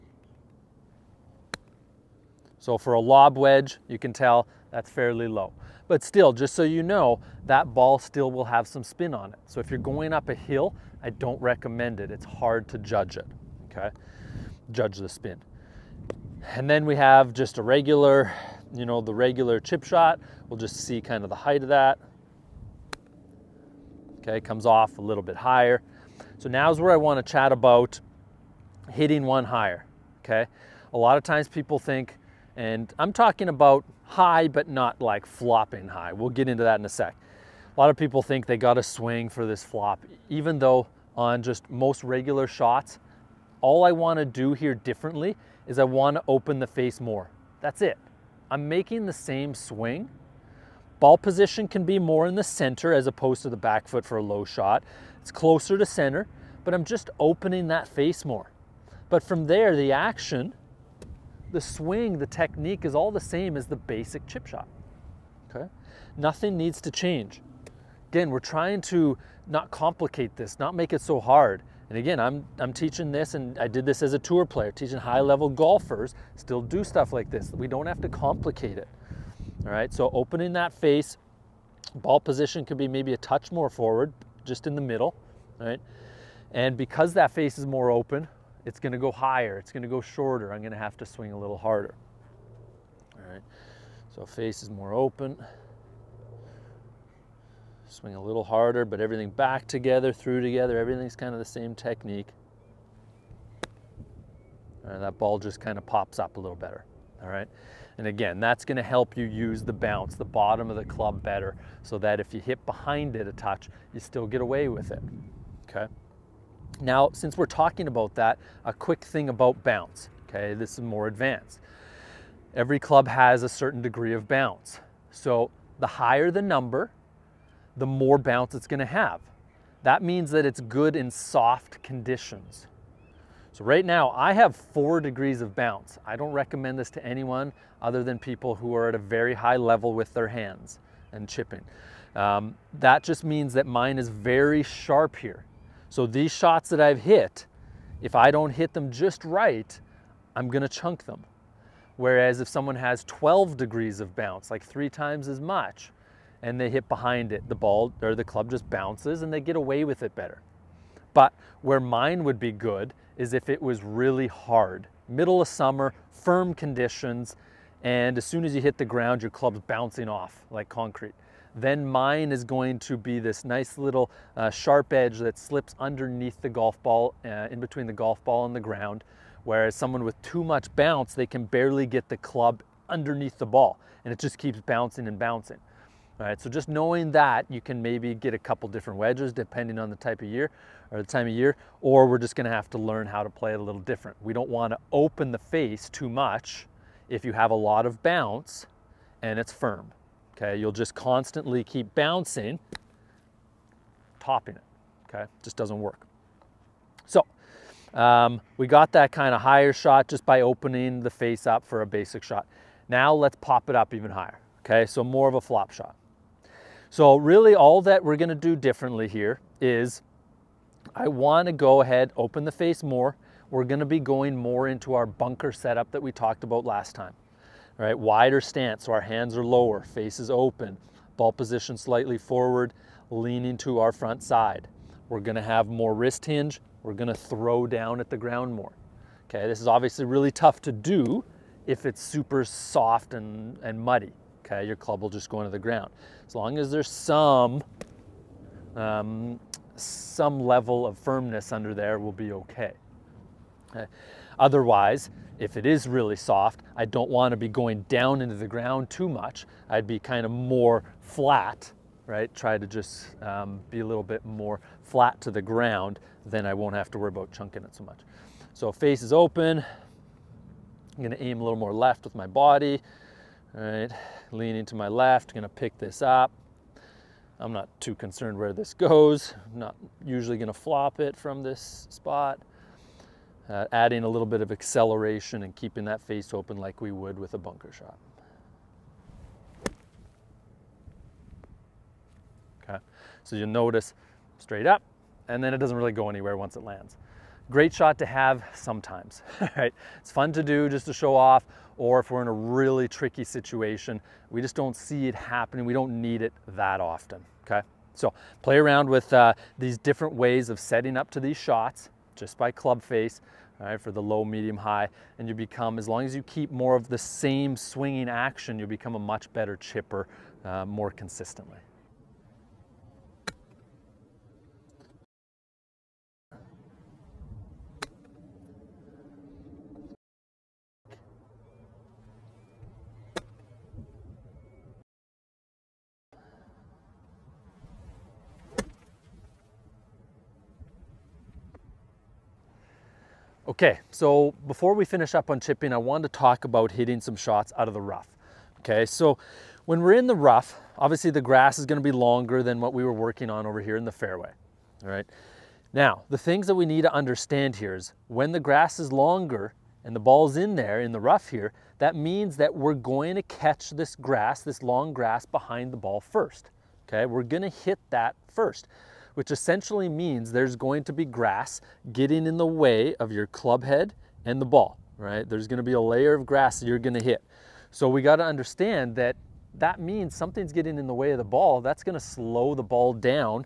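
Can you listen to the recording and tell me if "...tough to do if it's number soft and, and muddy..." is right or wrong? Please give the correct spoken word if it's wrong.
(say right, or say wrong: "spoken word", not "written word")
wrong: "super", not "number".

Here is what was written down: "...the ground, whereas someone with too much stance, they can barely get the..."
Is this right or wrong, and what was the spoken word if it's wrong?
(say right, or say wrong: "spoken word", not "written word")
wrong: "bounce", not "stance".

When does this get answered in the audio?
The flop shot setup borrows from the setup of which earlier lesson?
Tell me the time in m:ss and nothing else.
3:45.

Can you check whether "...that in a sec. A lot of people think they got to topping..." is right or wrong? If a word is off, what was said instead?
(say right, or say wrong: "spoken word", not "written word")
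wrong: "swing", not "topping".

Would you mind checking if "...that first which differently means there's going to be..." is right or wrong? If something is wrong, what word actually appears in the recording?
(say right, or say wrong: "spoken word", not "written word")
wrong: "essentially", not "differently".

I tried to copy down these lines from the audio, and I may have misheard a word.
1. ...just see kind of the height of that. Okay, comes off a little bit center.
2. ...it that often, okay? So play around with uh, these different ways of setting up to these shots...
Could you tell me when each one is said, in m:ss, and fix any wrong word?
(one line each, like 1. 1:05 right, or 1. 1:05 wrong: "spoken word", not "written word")
1. 0:20 wrong: "higher", not "center"
2. 5:06 right.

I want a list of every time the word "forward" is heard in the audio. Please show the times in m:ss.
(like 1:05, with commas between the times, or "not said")
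1:23, 3:52.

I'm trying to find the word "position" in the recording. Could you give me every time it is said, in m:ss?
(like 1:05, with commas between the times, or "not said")
0:51, 1:22, 3:51.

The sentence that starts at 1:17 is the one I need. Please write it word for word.
We don't have to complicate it.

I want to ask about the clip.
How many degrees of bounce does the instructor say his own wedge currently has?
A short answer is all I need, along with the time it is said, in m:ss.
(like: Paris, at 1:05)
4, at 2:14.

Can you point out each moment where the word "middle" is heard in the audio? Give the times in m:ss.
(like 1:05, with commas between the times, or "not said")
1:24, 2:45.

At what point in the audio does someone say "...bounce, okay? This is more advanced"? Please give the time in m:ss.
1:59.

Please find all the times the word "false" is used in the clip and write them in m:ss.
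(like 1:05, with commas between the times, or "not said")
not said.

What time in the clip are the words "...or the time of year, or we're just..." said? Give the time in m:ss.
3:10.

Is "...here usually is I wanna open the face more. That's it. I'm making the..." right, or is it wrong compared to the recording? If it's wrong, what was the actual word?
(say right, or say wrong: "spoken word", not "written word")
wrong: "differently", not "usually".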